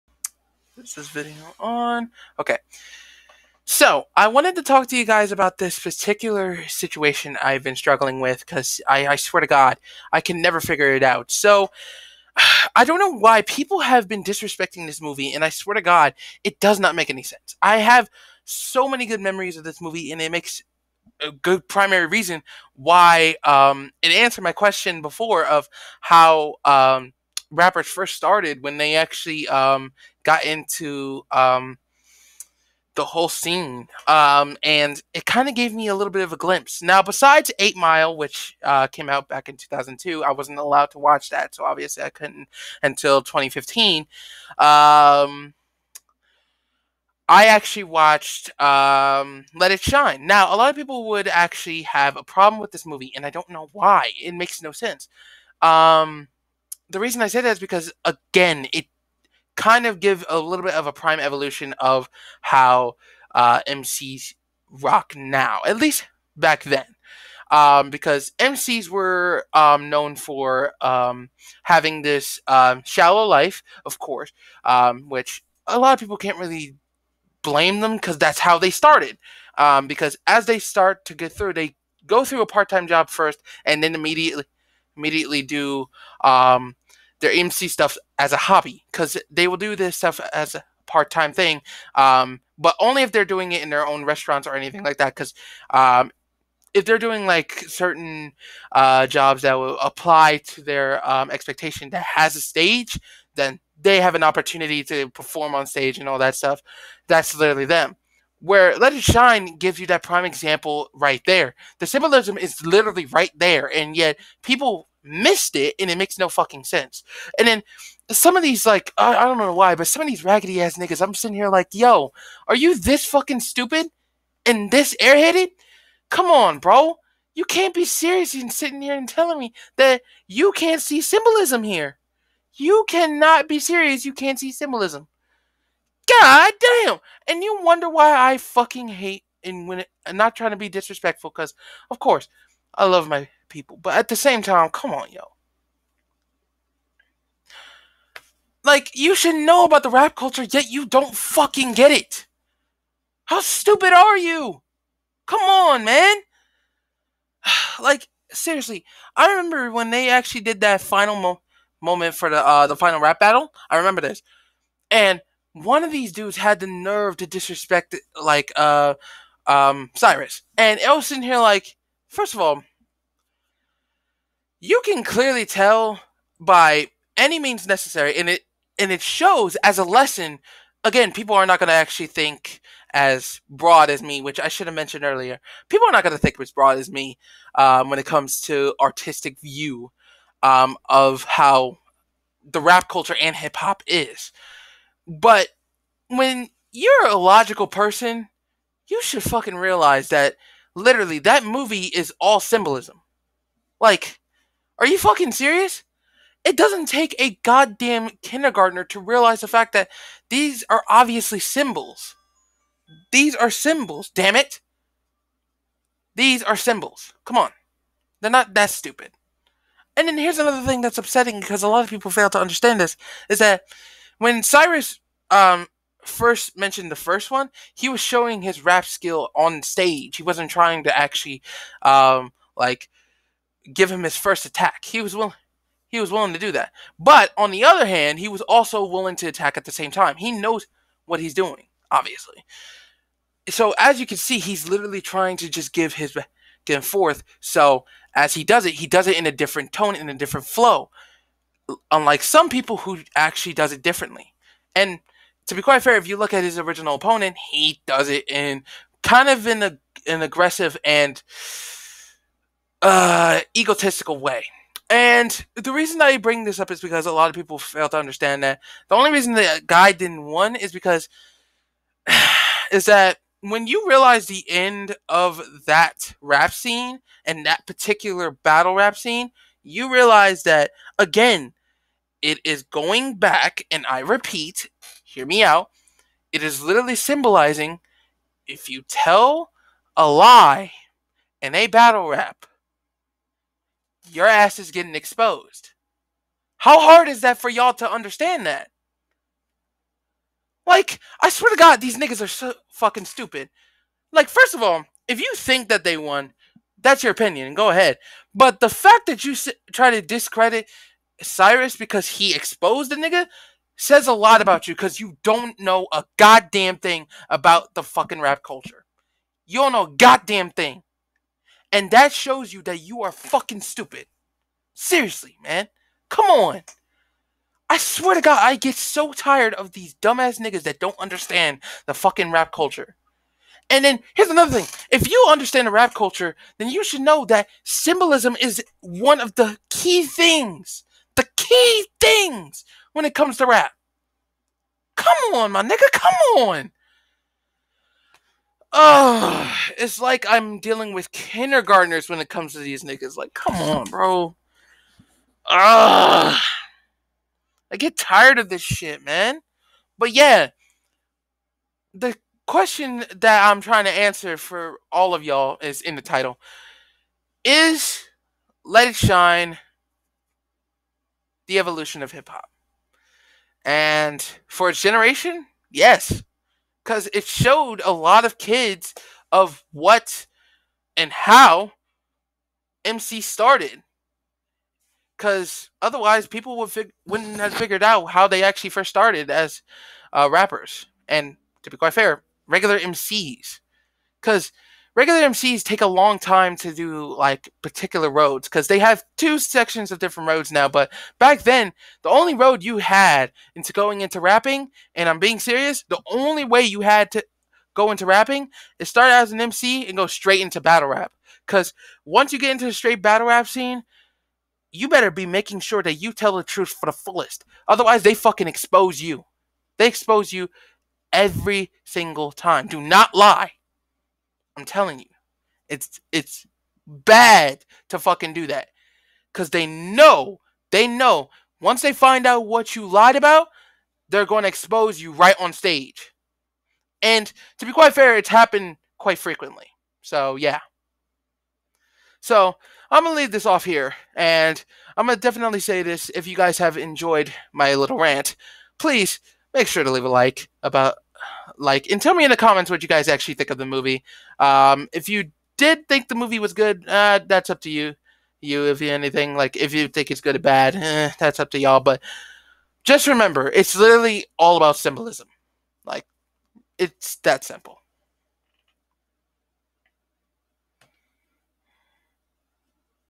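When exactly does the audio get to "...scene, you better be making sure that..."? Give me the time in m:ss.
6:53.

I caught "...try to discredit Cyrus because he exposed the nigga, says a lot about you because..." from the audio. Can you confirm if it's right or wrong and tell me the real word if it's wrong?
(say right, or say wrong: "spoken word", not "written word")
right.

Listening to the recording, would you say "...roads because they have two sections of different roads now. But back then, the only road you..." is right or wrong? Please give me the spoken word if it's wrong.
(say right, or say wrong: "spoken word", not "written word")
right.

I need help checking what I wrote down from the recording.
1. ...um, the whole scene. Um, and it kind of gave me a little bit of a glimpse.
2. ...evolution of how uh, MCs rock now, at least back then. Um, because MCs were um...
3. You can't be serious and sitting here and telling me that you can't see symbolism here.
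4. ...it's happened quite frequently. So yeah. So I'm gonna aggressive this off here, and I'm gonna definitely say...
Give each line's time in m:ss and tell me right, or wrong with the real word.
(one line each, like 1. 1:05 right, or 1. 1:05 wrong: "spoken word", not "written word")
1. 0:31 right
2. 1:01 right
3. 2:07 right
4. 7:18 wrong: "leave", not "aggressive".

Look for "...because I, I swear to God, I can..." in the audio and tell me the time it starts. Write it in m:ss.
0:08.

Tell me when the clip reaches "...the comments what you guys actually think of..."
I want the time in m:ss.
7:32.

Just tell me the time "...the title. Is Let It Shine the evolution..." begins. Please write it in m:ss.
6:05.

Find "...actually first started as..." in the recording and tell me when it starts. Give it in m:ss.
6:28.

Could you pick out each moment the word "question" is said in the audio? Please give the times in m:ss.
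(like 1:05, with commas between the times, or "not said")
0:24, 6:02.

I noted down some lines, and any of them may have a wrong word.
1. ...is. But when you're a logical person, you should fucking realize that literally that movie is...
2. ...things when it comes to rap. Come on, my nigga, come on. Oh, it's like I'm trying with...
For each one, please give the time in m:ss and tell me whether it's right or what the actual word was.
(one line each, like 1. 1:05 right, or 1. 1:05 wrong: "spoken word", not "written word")
1. 3:13 right
2. 5:41 wrong: "dealing", not "trying".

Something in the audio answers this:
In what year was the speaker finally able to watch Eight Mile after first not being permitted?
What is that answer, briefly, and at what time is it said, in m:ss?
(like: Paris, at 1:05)
2015, at 0:43.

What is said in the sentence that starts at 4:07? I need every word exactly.
So as he does it, he does it in a different tone, in a different flow.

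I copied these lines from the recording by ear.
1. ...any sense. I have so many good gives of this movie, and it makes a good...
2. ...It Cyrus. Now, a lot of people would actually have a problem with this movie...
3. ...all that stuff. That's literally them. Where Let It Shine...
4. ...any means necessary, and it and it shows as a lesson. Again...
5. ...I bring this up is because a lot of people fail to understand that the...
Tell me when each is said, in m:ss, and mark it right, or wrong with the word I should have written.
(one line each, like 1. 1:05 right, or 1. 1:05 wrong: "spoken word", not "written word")
1. 0:17 wrong: "memories", not "gives"
2. 0:49 wrong: "Shine", not "Cyrus"
3. 1:46 right
4. 2:57 right
5. 4:26 right.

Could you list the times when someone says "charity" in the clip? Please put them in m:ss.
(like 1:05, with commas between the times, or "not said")
not said.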